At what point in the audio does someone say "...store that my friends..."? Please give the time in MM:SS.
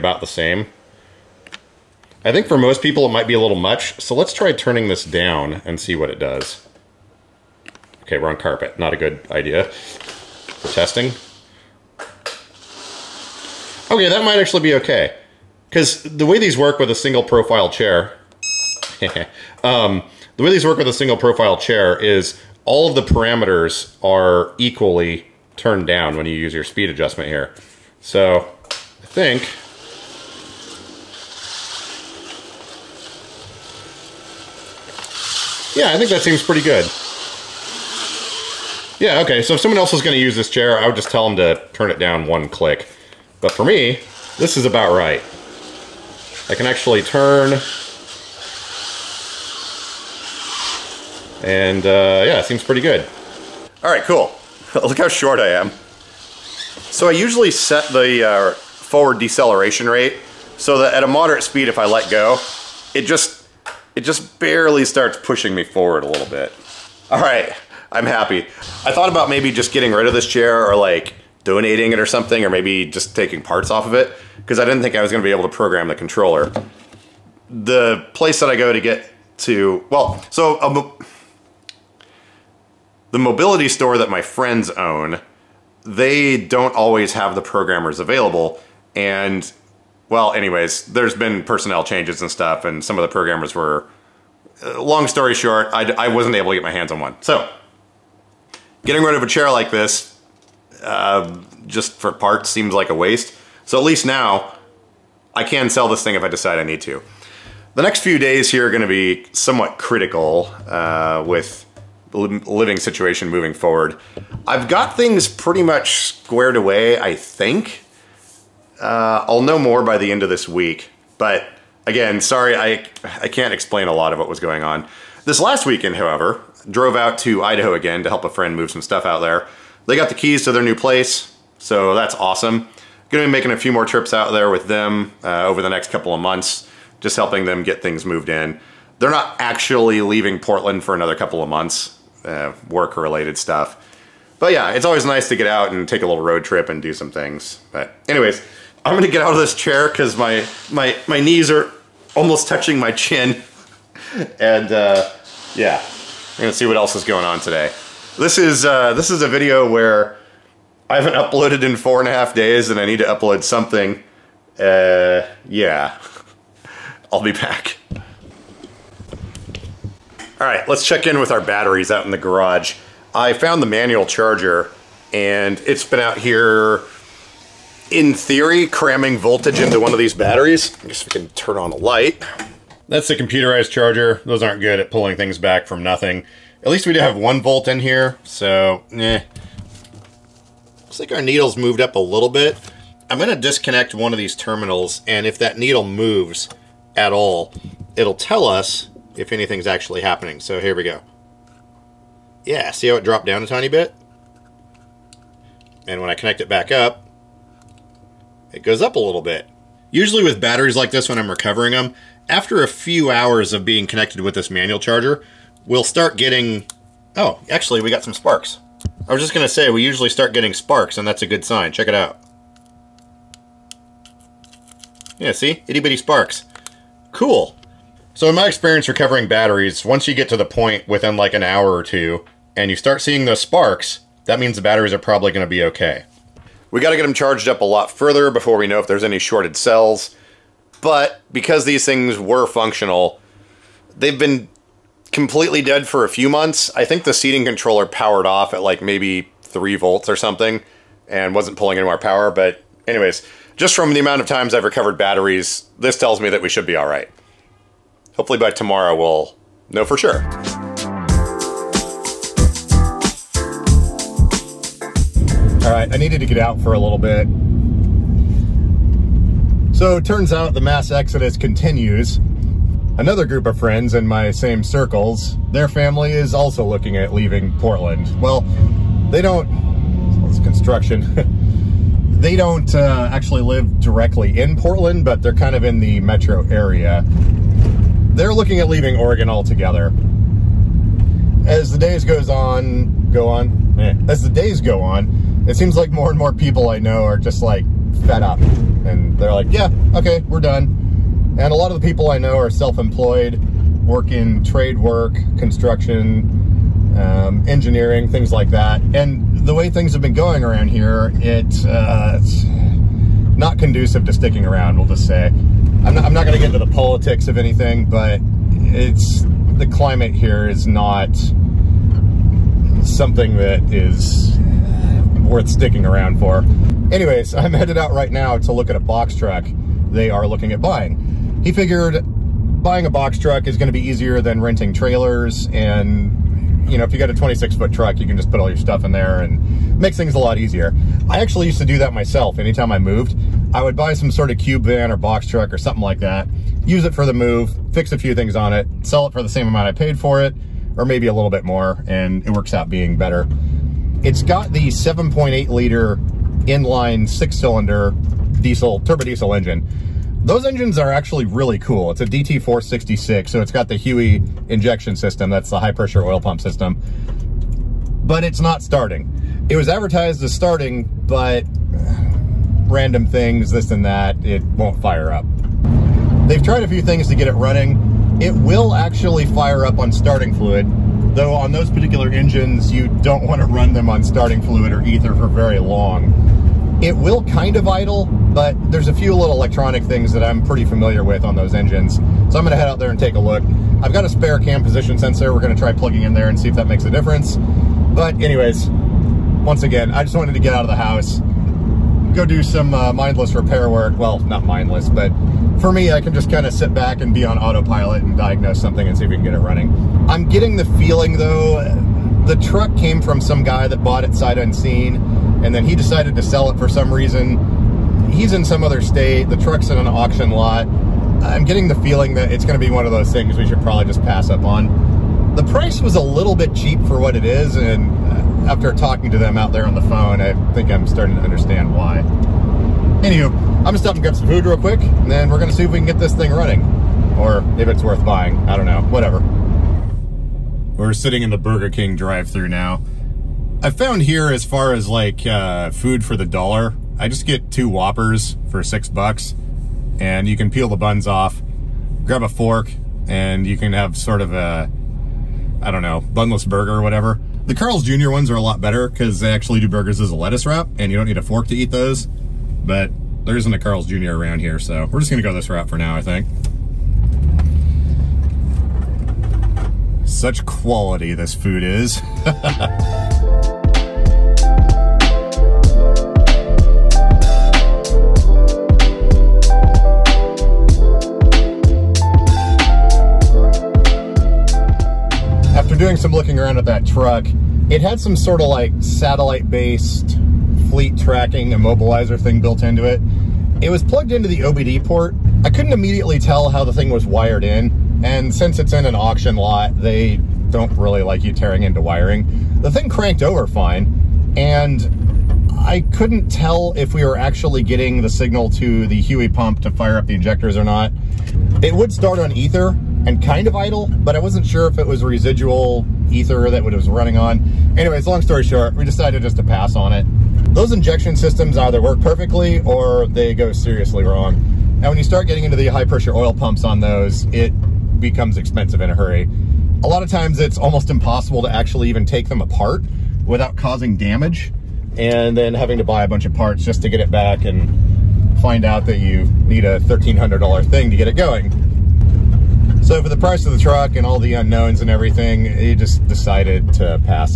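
01:23.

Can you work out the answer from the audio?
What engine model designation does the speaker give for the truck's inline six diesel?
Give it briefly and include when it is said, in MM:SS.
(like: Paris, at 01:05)
DT466, at 06:02.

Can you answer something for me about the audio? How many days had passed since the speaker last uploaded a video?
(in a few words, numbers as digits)
4 and a half.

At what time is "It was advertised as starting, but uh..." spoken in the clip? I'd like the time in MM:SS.
06:09.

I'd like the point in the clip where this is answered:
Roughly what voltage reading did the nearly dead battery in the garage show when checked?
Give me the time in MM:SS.
03:07.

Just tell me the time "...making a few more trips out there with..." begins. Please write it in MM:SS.
02:13.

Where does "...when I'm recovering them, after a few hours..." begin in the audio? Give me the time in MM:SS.
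03:31.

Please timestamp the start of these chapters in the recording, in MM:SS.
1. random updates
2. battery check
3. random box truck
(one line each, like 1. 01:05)
1. 01:47
2. 02:47
3. 04:24.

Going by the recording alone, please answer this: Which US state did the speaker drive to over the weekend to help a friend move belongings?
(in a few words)
Idaho.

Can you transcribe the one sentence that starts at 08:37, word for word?
Anyways, long story short, we decided just to pass on it.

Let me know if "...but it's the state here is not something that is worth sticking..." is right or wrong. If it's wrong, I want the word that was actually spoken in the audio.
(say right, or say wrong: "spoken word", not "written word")
wrong: "climate", not "state".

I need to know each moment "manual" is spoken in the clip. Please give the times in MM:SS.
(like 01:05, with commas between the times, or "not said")
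02:53, 03:34.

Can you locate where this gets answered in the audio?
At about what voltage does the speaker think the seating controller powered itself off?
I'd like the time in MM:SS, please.
04:09.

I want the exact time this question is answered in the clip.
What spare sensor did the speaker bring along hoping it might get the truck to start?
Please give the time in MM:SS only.
06:34.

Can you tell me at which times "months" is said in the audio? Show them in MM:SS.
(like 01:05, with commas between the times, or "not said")
02:16, 02:21, 04:06.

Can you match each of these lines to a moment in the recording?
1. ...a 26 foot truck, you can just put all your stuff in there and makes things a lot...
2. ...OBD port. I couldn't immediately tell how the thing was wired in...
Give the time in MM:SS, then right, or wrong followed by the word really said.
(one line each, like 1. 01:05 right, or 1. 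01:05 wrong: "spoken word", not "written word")
1. 05:37 right
2. 08:14 right.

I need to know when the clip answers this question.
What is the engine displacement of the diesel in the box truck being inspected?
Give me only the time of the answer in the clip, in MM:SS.
05:54.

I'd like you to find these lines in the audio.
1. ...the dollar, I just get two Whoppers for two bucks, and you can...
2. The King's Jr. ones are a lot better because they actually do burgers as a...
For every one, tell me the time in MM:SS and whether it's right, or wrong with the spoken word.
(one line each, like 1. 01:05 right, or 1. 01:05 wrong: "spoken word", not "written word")
1. 07:26 wrong: "six", not "two"
2. 07:37 wrong: "Carl", not "King".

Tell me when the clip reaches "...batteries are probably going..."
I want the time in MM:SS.
03:54.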